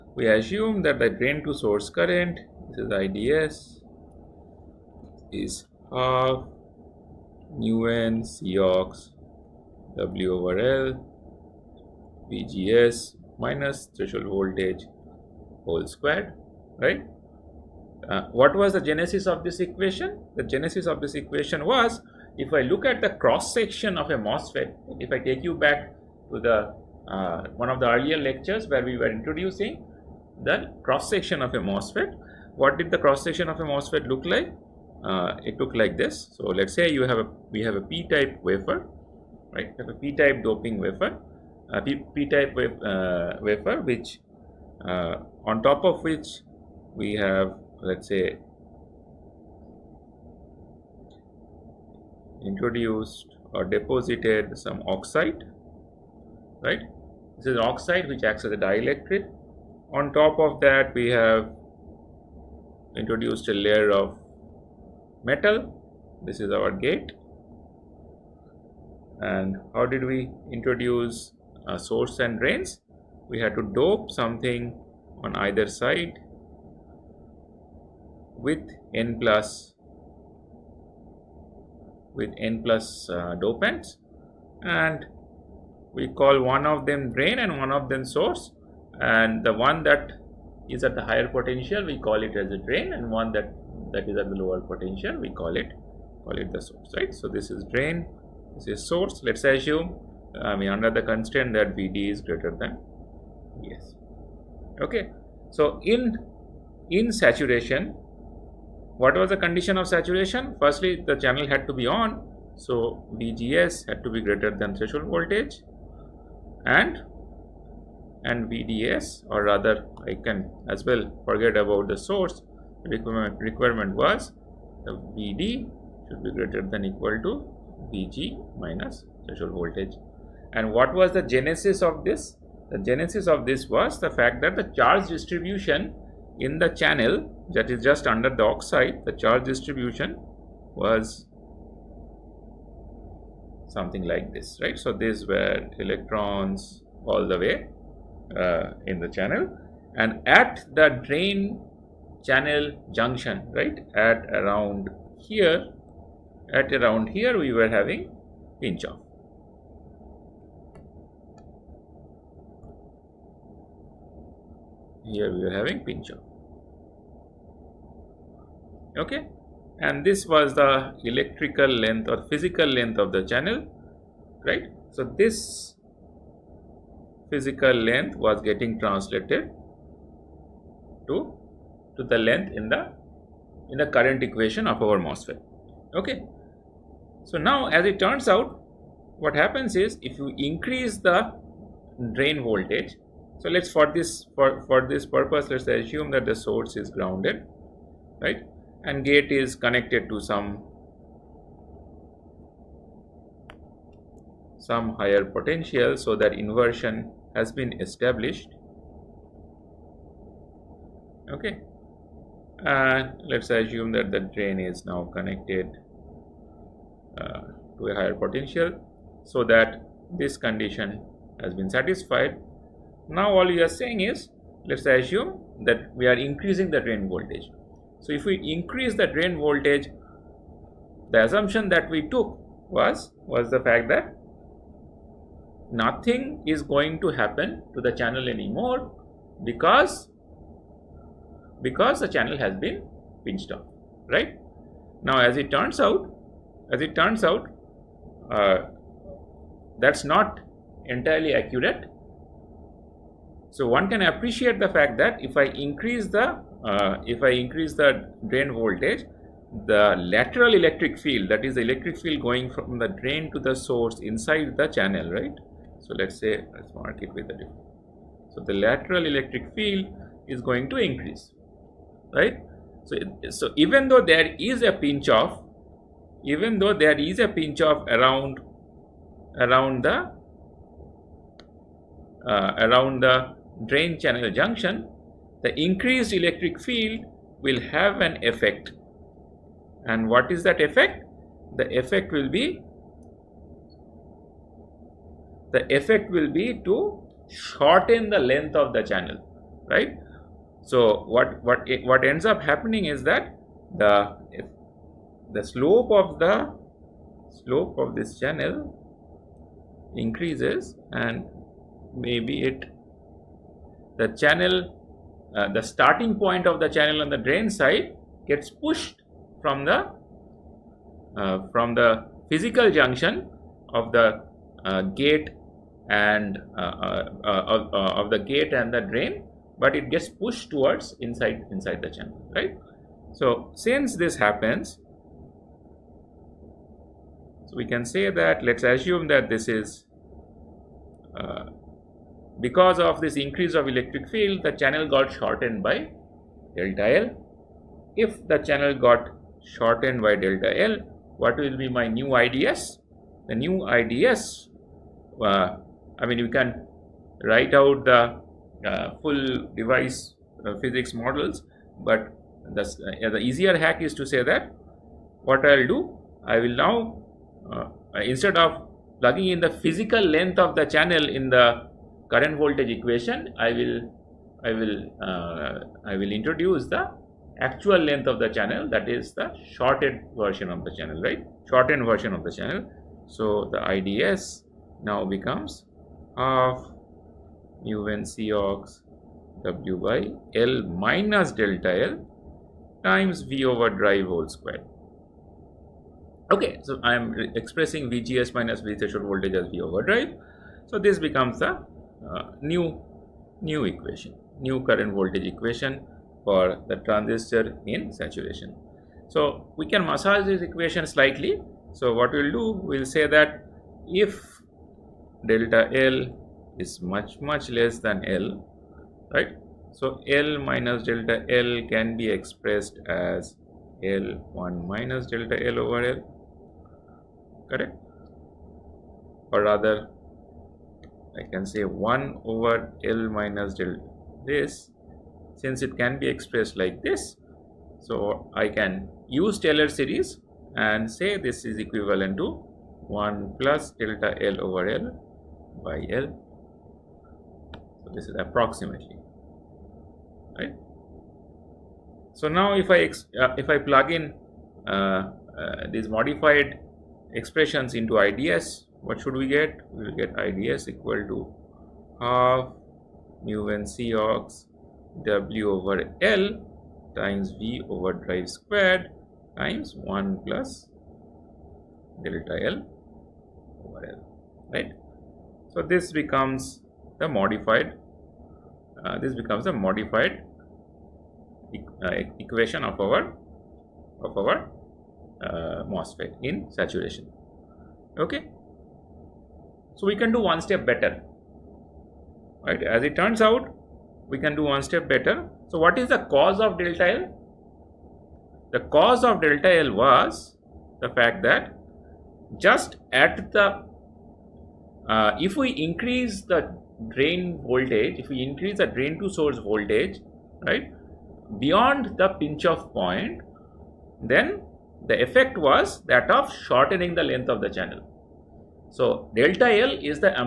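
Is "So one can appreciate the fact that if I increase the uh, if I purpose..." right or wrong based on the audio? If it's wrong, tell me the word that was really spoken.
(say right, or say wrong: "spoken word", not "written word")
wrong: "increase", not "purpose".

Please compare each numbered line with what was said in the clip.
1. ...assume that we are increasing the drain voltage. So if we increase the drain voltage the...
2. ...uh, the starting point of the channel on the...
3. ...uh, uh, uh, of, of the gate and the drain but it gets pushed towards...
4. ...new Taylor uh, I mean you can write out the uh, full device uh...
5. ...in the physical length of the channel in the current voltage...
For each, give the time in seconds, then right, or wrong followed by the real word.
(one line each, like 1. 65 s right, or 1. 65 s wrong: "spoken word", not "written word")
1. 224 s right
2. 315 s right
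3. 326 s right
4. 353 s wrong: "IDS", not "Taylor"
5. 369 s right.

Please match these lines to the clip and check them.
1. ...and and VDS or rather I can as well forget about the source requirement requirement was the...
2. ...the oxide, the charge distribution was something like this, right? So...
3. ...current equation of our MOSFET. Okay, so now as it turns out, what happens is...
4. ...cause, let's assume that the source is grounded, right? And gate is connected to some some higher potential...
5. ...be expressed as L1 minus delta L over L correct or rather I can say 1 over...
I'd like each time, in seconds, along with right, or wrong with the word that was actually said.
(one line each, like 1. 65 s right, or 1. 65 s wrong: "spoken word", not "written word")
1. 116 s right
2. 138 s right
3. 183 s right
4. 195 s wrong: "purpose", not "cause"
5. 421 s right.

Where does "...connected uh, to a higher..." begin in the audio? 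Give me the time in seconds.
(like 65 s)
215 s.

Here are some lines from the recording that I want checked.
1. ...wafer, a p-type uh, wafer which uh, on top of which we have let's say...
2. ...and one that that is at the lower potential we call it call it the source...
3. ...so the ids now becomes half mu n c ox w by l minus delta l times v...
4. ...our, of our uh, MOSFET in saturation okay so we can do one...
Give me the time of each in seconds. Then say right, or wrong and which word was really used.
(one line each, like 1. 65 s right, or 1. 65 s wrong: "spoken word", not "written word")
1. 40 s right
2. 92 s right
3. 383 s right
4. 482 s right.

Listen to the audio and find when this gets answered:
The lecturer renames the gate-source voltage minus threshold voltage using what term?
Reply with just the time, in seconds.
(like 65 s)
399 s.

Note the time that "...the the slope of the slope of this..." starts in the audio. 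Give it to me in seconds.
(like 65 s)
303 s.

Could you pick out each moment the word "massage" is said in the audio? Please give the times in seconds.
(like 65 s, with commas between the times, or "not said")
409 s.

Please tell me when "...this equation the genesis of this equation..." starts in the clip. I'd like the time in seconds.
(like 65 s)
19 s.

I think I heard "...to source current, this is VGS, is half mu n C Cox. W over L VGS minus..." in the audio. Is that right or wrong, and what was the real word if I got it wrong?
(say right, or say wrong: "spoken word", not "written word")
wrong: "IDS", not "VGS".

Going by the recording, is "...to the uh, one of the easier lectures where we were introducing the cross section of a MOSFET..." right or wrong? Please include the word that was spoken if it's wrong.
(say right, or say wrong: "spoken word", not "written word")
wrong: "earlier", not "easier".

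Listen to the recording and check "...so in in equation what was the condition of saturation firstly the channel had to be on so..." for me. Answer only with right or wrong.
wrong.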